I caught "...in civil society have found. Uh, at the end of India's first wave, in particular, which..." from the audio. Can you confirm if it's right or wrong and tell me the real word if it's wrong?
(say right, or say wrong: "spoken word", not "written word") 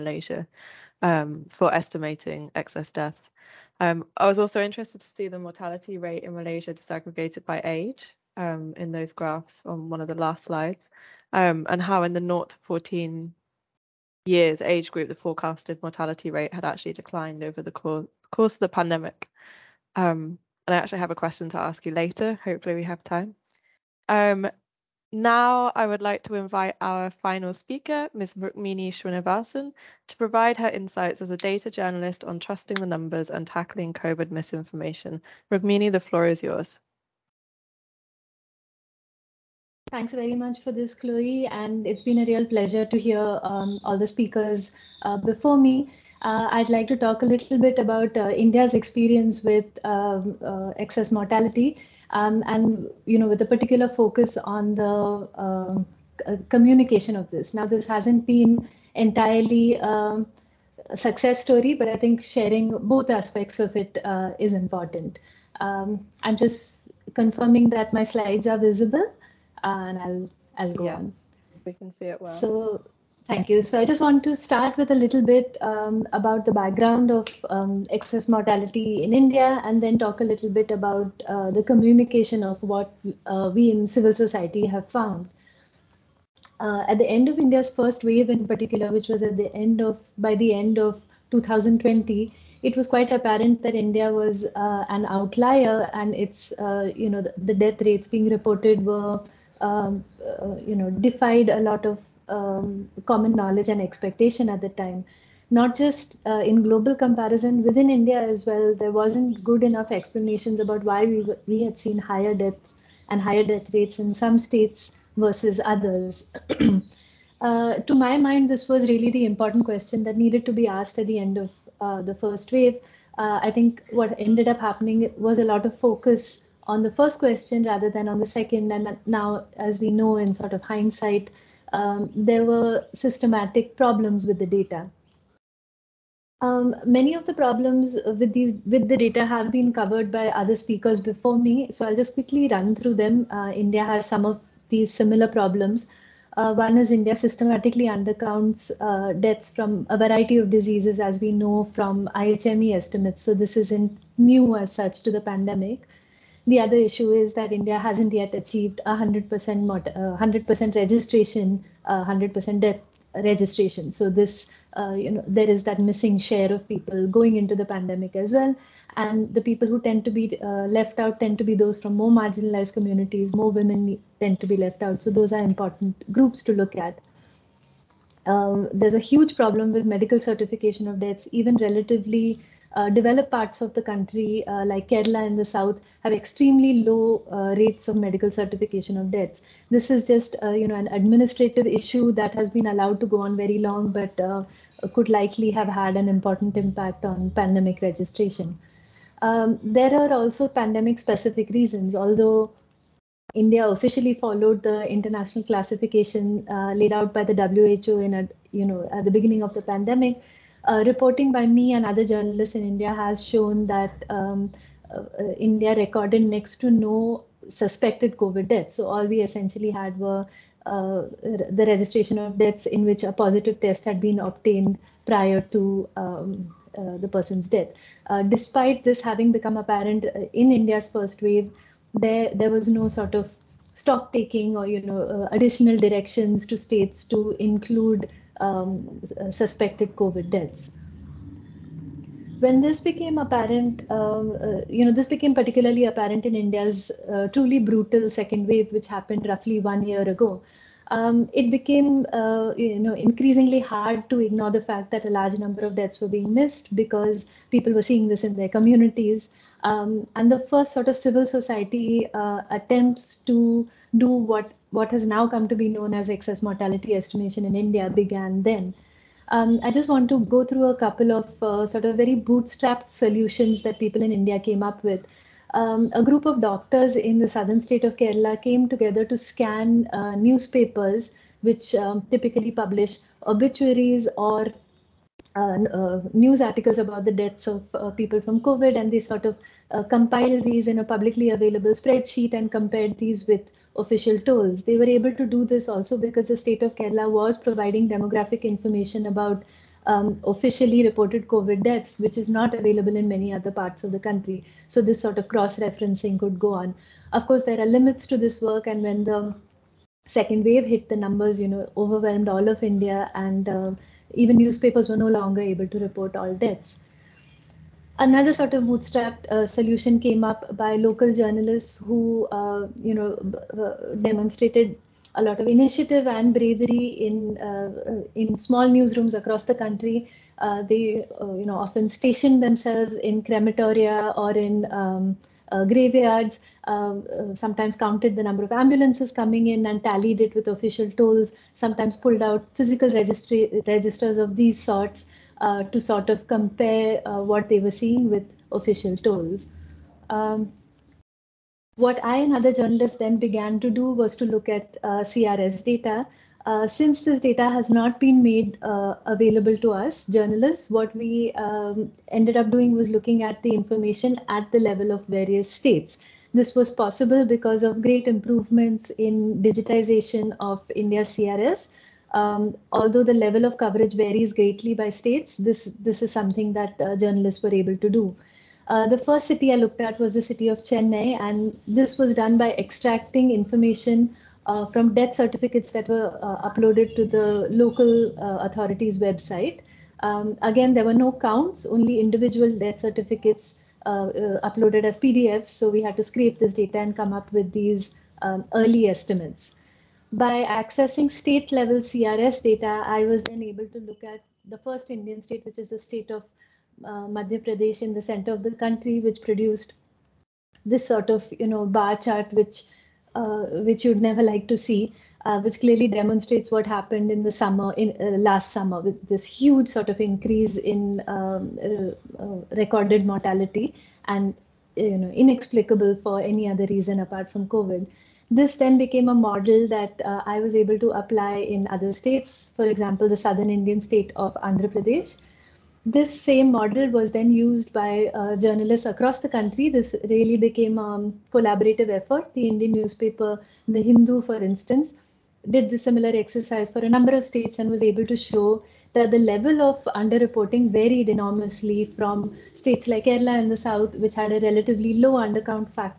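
right.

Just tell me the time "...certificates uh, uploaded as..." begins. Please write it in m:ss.
6:32.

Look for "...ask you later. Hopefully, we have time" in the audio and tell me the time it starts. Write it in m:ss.
0:21.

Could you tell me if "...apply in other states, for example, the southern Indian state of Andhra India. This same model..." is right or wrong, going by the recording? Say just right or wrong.
wrong.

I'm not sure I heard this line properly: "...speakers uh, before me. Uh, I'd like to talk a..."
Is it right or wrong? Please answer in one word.
right.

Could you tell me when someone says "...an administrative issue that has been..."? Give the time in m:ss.
3:10.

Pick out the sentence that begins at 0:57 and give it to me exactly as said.
Now, this hasn't been entirely um, a success story, but I think sharing both aspects of it uh, is important.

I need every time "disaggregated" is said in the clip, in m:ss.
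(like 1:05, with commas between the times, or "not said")
0:06.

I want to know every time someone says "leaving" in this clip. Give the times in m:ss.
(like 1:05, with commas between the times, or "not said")
not said.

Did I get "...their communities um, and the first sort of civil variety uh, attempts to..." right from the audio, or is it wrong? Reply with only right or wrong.
wrong.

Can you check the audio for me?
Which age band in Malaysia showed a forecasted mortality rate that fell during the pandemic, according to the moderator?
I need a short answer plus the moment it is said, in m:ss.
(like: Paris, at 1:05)
0 to 14 years, at 0:12.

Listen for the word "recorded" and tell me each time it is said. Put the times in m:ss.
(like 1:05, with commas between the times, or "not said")
3:35, 7:02.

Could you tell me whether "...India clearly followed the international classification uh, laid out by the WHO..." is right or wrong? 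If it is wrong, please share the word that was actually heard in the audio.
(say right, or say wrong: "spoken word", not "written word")
wrong: "officially", not "clearly".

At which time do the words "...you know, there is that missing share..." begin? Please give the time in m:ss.
2:44.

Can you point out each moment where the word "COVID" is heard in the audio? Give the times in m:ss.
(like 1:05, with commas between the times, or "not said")
0:33, 3:38, 3:59, 4:48, 5:01, 7:07.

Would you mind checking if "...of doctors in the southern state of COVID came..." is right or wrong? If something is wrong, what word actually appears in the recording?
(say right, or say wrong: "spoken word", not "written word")
wrong: "Kerala", not "COVID".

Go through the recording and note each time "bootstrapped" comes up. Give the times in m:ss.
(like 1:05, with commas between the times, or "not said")
4:32, 5:18.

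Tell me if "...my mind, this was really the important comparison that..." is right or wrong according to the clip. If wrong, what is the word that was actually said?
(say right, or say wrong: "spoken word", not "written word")
wrong: "question", not "comparison".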